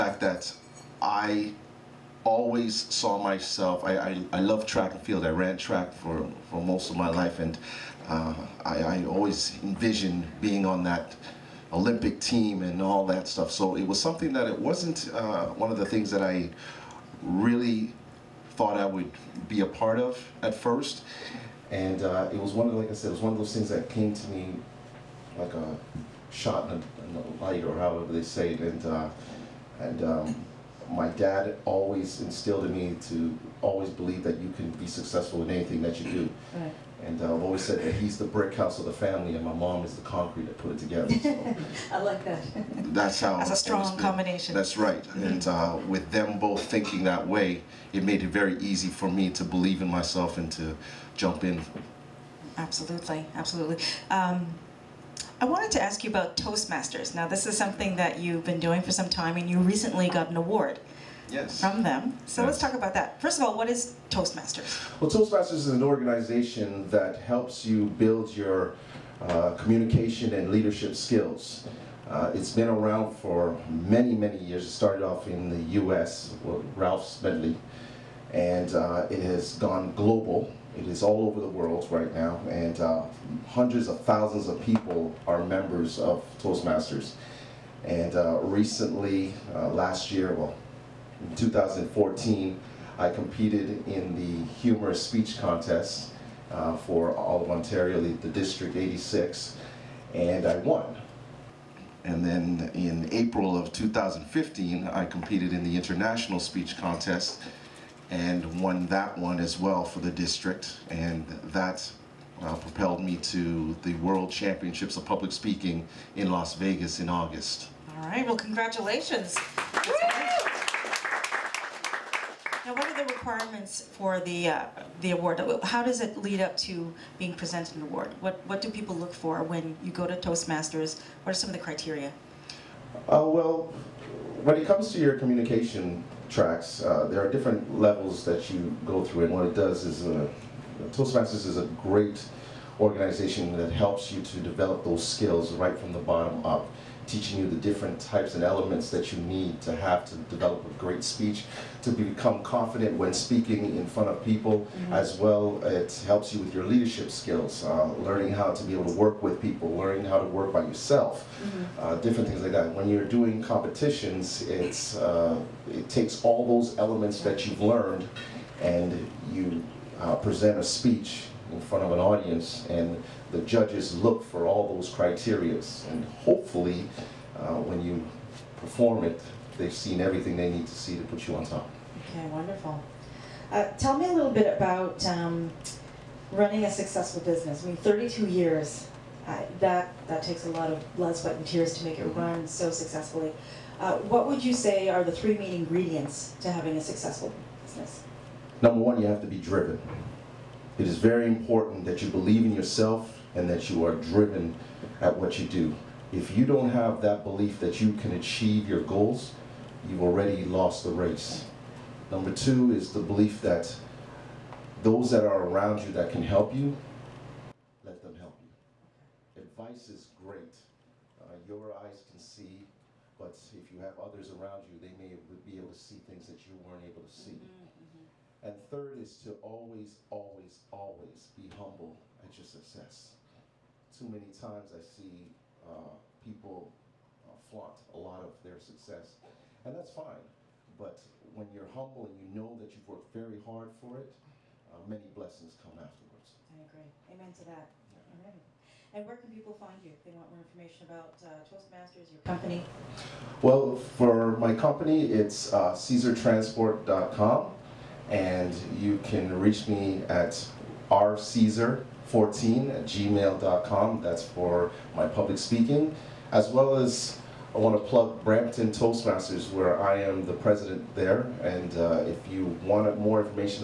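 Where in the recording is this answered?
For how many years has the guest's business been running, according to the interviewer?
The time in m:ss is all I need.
3:07.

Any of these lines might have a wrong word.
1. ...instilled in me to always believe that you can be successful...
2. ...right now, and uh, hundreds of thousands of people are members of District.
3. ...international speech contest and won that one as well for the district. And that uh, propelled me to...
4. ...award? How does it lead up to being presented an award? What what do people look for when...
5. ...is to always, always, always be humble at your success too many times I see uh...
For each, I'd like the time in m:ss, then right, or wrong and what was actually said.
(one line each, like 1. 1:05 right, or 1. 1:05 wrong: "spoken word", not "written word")
1. 0:32 right
2. 1:21 wrong: "Toastmasters", not "District"
3. 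1:45 right
4. 2:05 right
5. 3:49 right.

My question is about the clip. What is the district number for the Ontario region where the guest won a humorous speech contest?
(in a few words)
86.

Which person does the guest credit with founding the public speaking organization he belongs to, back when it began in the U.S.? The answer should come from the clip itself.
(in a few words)
Ralph Smedley.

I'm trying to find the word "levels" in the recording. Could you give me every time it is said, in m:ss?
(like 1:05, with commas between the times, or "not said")
2:17.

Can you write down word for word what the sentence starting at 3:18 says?
Number one, you have to be driven.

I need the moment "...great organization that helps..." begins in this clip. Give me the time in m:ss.
2:21.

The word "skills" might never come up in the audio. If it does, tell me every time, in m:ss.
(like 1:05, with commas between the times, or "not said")
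1:10, 2:25, 2:37.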